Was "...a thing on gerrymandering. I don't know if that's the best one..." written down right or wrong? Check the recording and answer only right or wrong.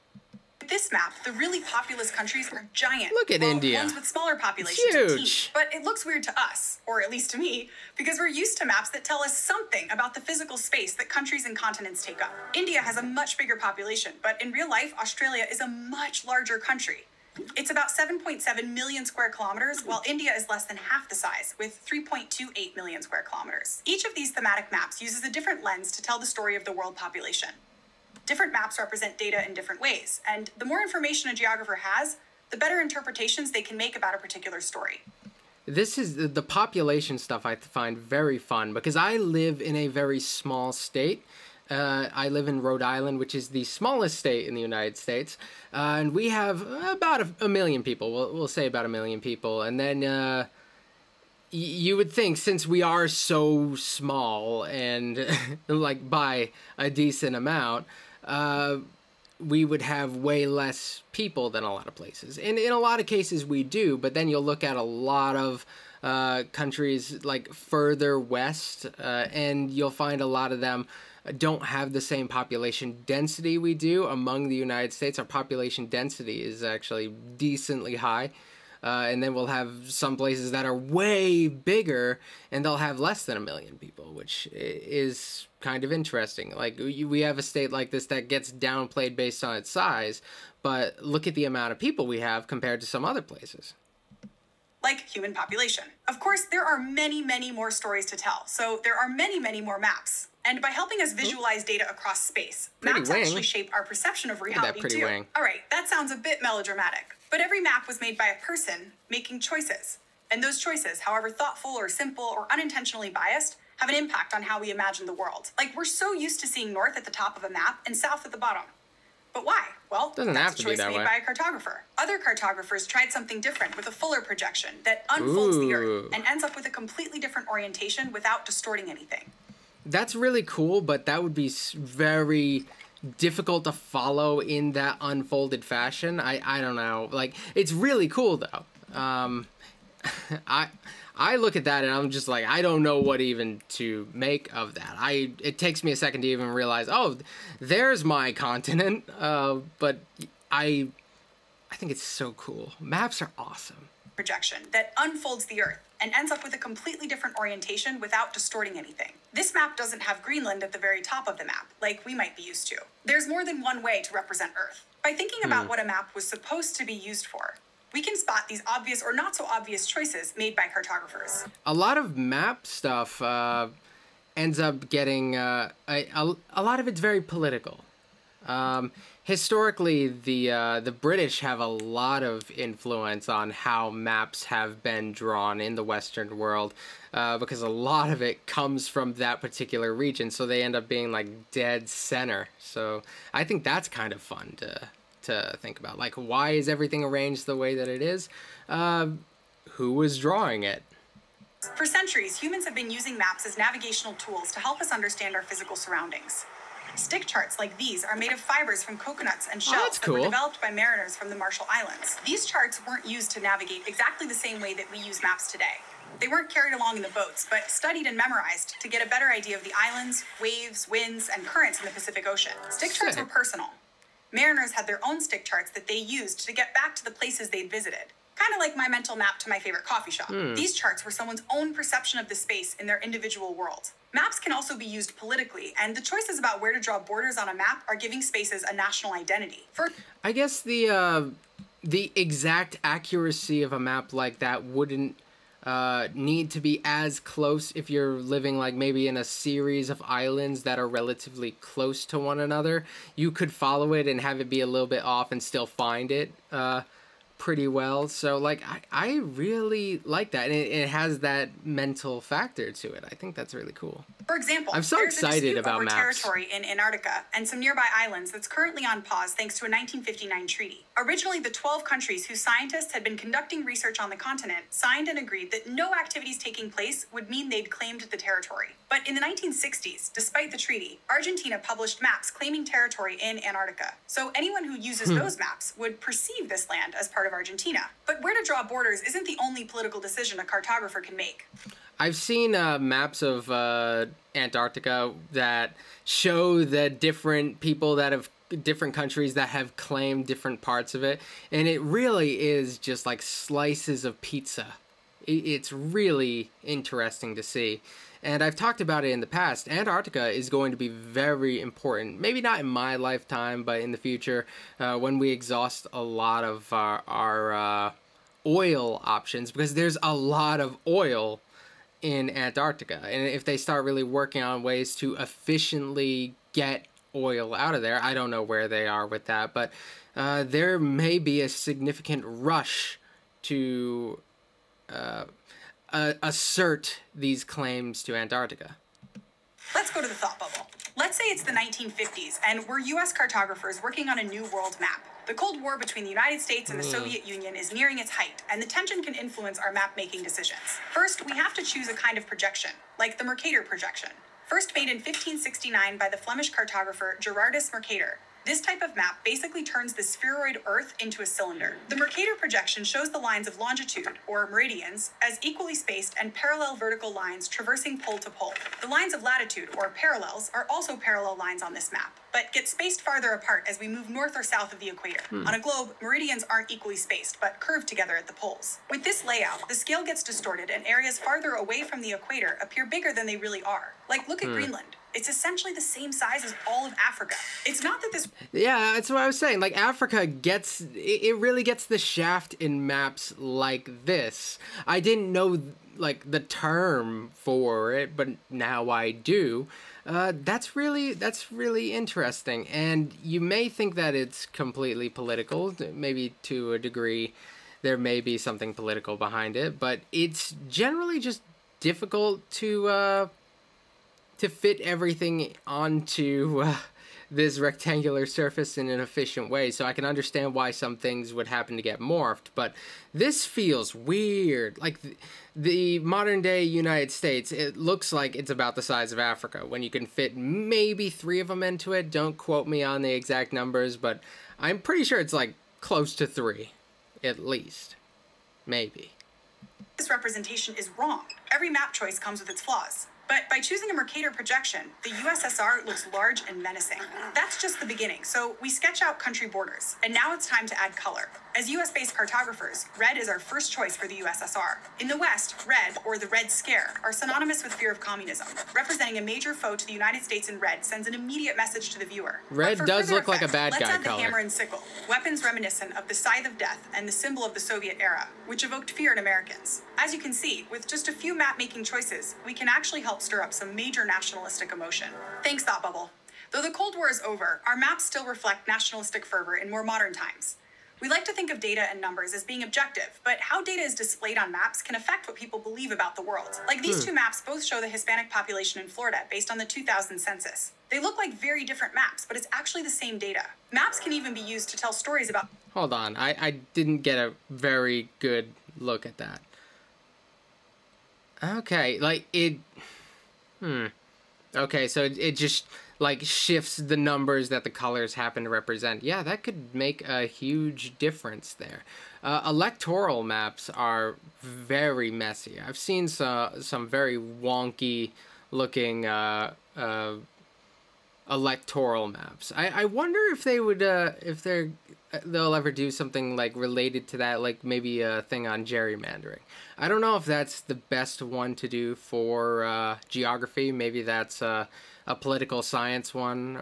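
right.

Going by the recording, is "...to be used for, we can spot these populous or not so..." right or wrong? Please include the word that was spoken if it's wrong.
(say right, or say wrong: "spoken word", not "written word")
wrong: "obvious", not "populous".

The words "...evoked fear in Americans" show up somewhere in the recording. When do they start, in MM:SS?
07:48.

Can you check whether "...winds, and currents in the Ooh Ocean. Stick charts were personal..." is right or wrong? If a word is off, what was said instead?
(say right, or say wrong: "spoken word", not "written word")
wrong: "Pacific", not "Ooh".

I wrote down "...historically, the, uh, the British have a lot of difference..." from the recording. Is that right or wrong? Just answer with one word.
wrong.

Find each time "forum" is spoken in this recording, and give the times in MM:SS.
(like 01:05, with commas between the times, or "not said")
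not said.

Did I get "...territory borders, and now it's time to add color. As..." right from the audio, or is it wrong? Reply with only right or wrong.
wrong.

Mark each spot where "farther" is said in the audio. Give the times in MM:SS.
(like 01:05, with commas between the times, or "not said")
06:13, 06:21.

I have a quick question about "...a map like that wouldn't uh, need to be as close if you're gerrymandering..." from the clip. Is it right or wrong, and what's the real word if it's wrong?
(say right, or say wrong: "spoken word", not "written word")
wrong: "living", not "gerrymandering".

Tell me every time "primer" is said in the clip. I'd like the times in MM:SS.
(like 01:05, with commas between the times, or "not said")
not said.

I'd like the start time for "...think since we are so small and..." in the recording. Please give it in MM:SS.
00:52.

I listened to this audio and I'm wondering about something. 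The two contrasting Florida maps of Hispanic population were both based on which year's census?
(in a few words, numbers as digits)
2000.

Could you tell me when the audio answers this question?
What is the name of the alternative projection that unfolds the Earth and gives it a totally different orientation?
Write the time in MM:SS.
02:03.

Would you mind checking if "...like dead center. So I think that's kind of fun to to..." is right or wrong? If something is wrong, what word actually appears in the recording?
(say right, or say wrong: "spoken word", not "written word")
right.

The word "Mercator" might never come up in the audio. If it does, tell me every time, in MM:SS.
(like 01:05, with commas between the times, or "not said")
05:53, 05:57, 06:01, 07:23.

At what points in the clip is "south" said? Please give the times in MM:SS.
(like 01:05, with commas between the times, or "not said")
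01:57, 06:14.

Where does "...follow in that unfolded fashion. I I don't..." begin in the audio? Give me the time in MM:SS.
02:13.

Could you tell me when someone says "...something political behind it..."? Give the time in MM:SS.
06:48.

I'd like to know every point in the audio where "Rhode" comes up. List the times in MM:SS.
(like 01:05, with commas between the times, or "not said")
00:42.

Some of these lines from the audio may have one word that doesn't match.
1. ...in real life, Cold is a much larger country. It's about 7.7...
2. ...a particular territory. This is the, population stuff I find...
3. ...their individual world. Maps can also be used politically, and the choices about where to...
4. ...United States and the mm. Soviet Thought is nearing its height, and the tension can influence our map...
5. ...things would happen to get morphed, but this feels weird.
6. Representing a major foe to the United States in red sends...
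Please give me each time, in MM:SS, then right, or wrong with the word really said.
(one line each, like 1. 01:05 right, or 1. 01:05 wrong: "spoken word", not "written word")
1. 00:14 wrong: "Australia", not "Cold"
2. 00:34 wrong: "story", not "territory"
3. 03:52 right
4. 05:46 wrong: "Union", not "Thought"
5. 07:00 right
6. 07:38 right.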